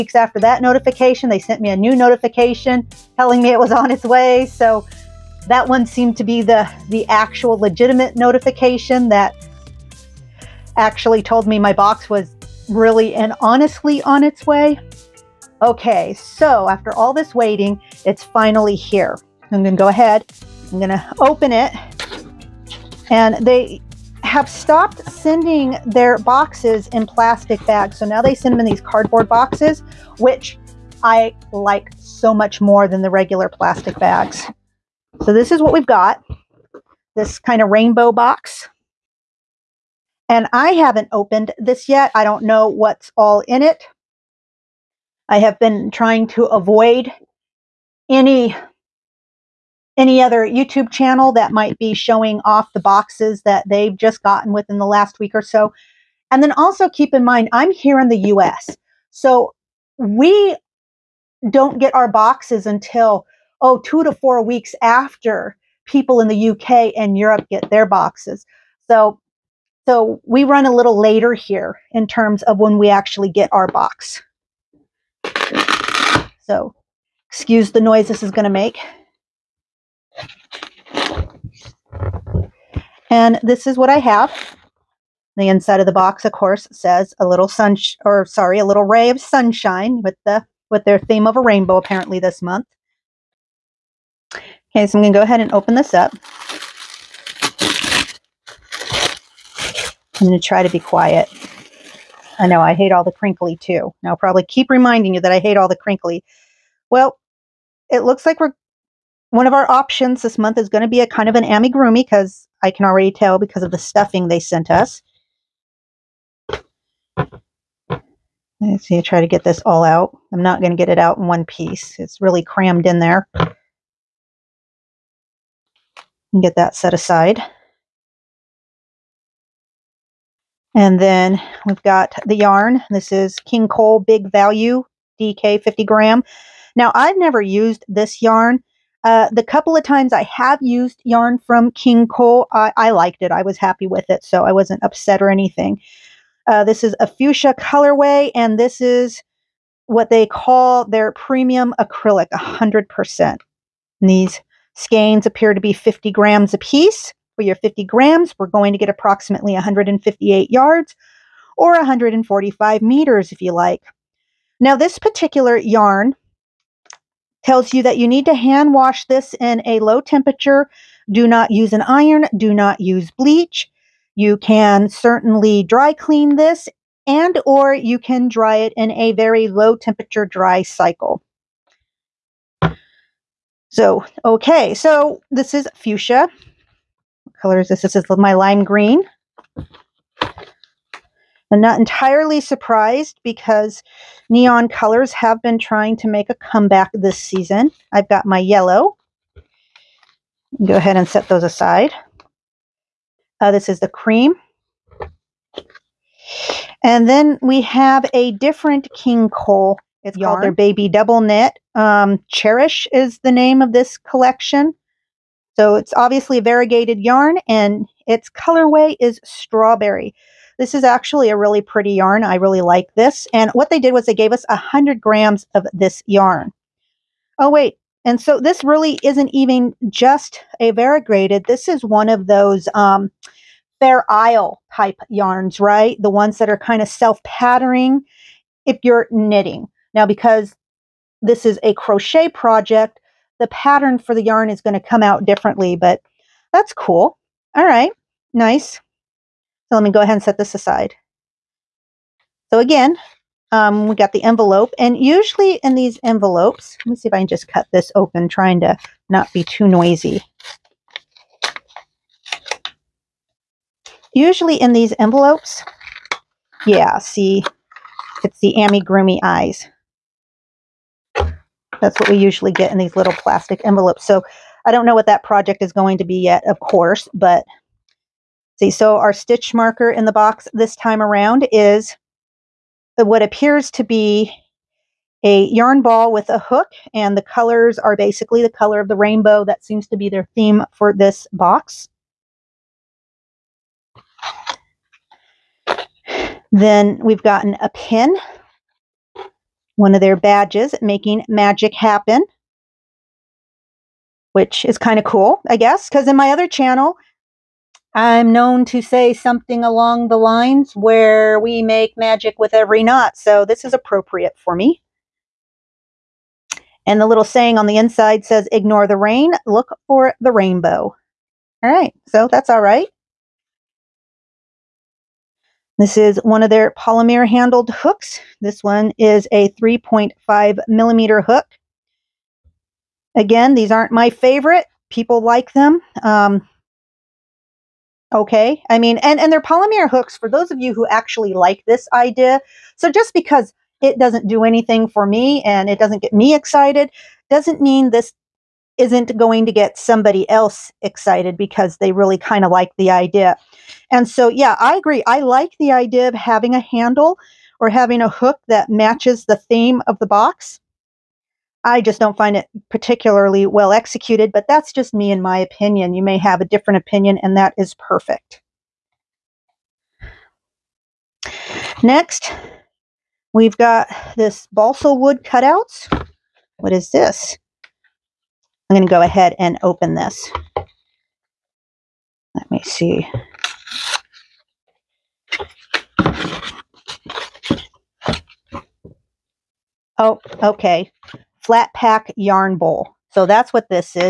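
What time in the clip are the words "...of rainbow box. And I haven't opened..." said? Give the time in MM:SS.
00:37.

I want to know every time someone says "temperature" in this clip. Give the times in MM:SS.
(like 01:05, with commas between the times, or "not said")
02:50, 02:59.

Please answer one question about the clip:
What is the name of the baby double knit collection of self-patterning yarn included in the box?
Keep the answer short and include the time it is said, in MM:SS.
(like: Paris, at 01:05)
Cherish, at 03:32.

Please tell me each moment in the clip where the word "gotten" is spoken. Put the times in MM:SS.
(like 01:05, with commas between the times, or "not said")
00:54, 04:57.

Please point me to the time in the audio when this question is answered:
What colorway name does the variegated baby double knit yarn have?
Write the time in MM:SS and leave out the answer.
03:39.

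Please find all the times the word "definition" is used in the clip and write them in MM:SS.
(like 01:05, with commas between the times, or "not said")
not said.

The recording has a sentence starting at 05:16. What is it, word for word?
And the little saying on the inside says, ignore the rain, look for the rainbow.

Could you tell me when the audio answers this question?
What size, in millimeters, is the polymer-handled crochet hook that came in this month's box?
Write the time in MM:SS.
05:29.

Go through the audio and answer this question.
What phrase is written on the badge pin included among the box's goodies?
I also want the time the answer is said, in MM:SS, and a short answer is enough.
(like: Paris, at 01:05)
Making Magic Happen, at 05:00.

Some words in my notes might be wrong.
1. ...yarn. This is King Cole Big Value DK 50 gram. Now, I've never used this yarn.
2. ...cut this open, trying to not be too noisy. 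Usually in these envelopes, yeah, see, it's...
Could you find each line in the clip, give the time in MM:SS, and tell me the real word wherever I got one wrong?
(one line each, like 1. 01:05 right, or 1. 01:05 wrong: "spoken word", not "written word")
1. 02:12 right
2. 04:17 right.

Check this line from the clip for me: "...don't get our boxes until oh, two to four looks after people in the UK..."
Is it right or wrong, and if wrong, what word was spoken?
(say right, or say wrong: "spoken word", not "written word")
wrong: "weeks", not "looks".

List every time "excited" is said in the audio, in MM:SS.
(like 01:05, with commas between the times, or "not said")
05:46, 05:50.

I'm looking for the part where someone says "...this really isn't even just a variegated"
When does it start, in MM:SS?
03:48.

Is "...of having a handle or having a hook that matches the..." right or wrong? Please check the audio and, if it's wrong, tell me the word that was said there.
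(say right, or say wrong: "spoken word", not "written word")
right.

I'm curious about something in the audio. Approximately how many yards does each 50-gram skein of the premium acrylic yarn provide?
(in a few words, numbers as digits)
158.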